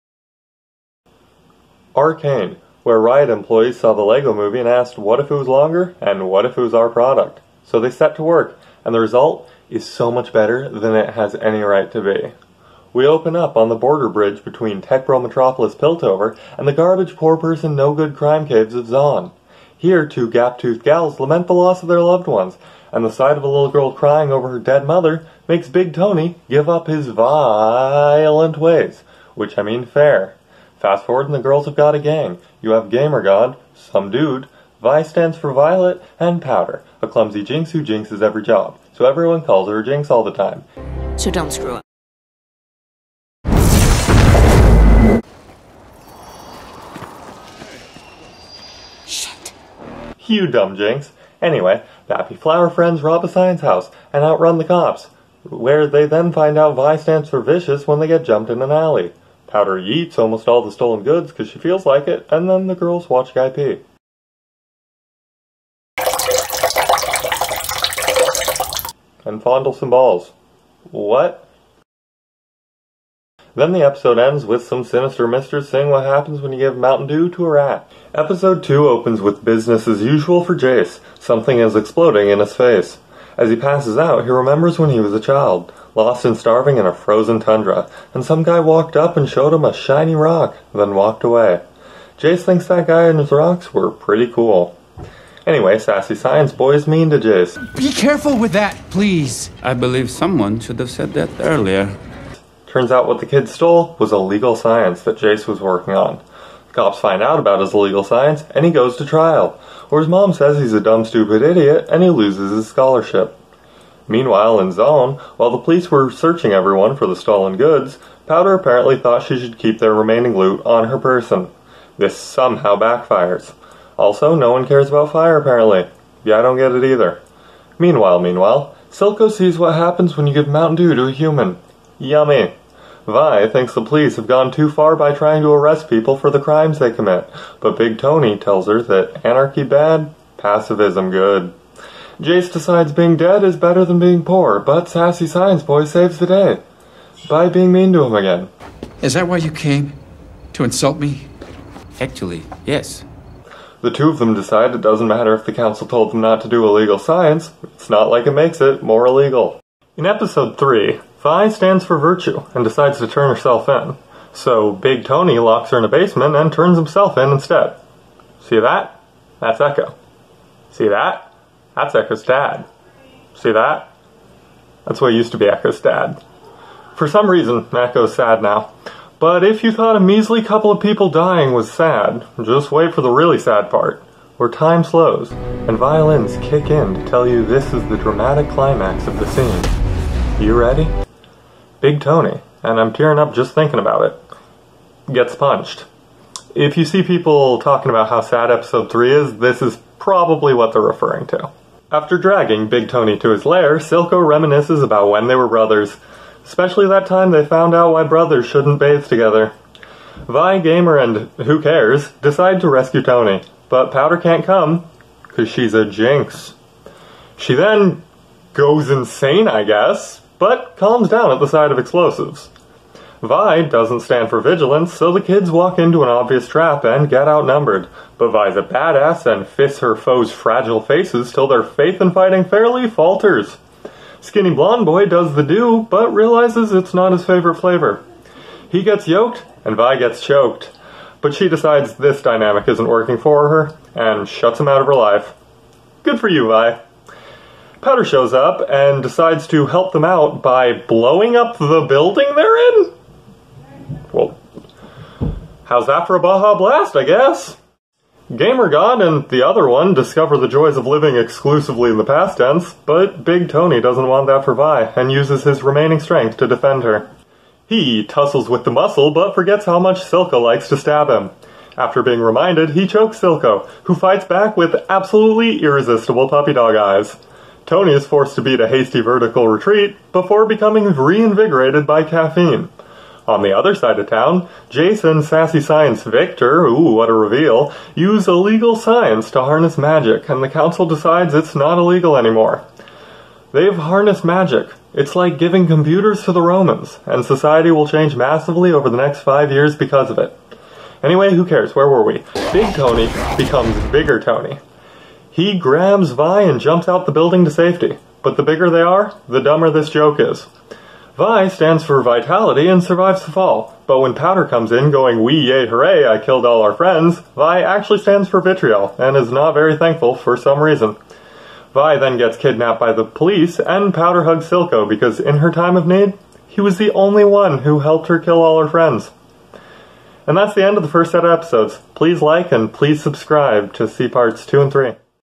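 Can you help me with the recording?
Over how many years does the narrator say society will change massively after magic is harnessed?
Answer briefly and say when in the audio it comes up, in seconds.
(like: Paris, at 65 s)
5, at 299 s.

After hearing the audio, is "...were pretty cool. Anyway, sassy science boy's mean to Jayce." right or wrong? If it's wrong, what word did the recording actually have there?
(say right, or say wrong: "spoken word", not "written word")
right.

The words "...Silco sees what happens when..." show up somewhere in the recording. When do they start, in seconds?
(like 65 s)
128 s.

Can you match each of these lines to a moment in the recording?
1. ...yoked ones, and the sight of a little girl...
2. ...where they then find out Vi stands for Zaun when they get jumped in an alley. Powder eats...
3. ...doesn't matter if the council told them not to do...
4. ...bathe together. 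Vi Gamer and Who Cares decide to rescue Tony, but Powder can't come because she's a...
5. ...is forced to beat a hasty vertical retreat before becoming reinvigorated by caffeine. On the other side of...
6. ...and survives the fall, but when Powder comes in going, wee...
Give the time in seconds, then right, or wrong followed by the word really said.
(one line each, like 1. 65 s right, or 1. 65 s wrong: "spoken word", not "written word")
1. 22 s wrong: "loved", not "yoked"
2. 55 s wrong: "Vicious", not "Zaun"
3. 154 s right
4. 208 s right
5. 277 s right
6. 312 s right.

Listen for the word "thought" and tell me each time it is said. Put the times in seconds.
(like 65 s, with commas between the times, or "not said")
118 s, 179 s.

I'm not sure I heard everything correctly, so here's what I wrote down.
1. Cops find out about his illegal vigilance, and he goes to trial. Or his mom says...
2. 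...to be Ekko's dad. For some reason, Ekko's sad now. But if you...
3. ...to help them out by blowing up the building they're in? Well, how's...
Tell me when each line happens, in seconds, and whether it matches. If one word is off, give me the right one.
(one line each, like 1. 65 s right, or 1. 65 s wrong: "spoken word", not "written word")
1. 106 s wrong: "science", not "vigilance"
2. 175 s right
3. 249 s right.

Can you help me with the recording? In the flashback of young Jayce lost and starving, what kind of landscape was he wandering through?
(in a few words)
frozen tundra.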